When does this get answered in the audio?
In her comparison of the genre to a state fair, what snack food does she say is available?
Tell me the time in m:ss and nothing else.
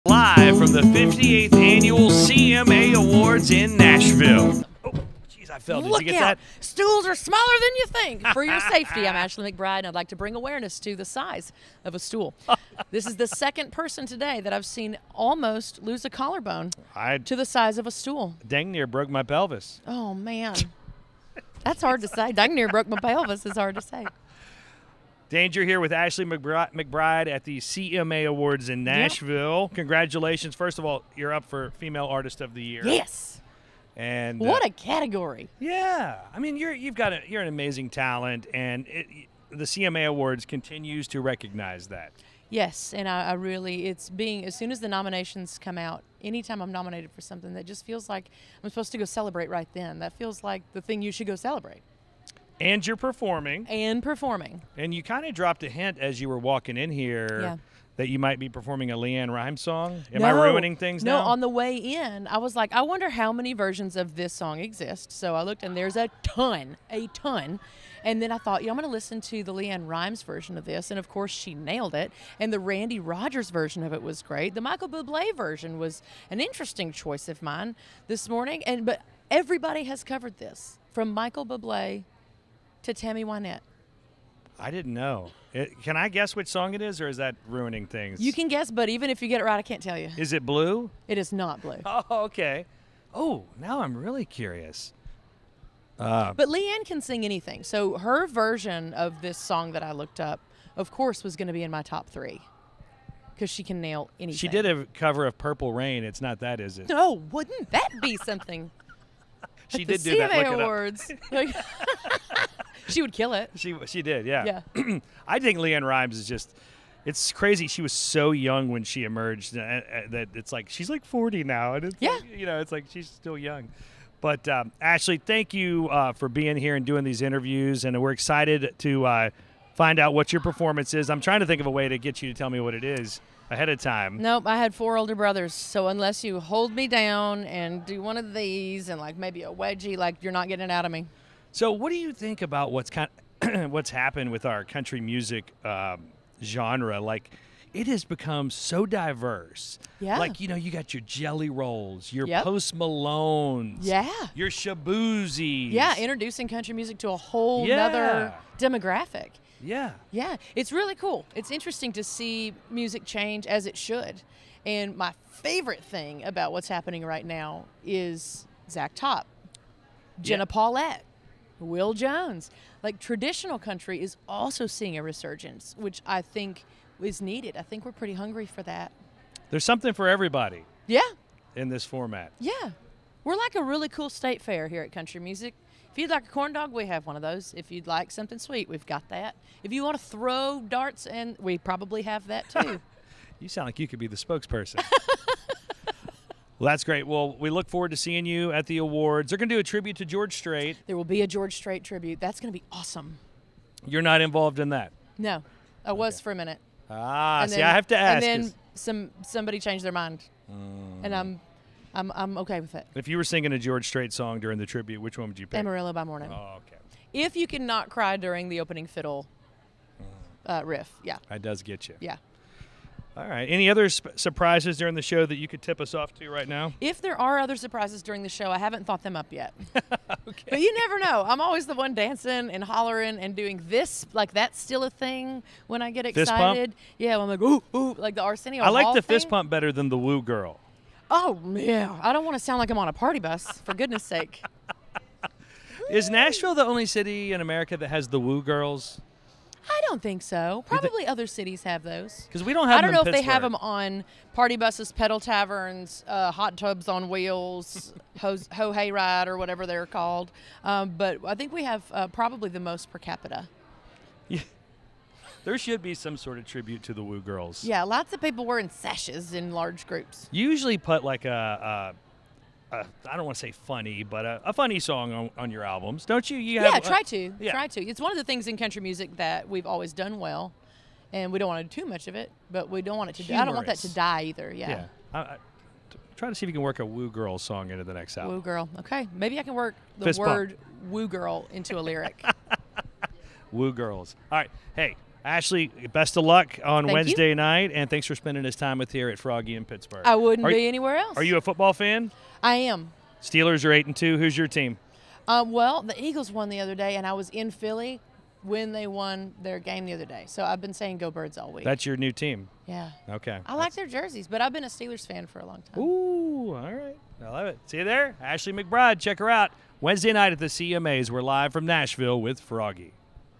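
3:06.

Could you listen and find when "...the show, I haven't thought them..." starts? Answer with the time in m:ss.
3:48.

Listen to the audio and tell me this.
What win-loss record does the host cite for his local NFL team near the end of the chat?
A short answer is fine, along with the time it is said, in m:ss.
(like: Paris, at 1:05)
8 and 2, at 5:03.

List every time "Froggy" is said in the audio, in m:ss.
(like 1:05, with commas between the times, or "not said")
4:59, 5:22.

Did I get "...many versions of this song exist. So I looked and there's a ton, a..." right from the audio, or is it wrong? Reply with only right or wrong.
right.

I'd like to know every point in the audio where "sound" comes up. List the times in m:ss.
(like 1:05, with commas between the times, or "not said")
3:13, 4:02.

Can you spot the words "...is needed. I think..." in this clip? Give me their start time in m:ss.
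2:57.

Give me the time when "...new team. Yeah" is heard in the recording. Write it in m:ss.
5:11.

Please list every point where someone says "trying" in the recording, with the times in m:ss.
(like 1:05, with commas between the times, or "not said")
2:11.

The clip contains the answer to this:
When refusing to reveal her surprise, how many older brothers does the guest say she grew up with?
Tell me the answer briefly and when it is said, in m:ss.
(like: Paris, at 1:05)
4, at 2:14.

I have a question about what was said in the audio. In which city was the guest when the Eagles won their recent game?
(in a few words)
Philly.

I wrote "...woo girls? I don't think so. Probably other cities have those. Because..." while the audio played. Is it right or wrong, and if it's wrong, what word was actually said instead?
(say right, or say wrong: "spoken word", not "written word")
right.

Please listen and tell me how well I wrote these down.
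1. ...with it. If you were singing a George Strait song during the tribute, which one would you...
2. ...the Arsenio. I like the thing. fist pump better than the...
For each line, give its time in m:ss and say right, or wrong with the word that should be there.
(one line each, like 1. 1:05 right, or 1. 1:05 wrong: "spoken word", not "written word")
1. 3:32 right
2. 3:58 right.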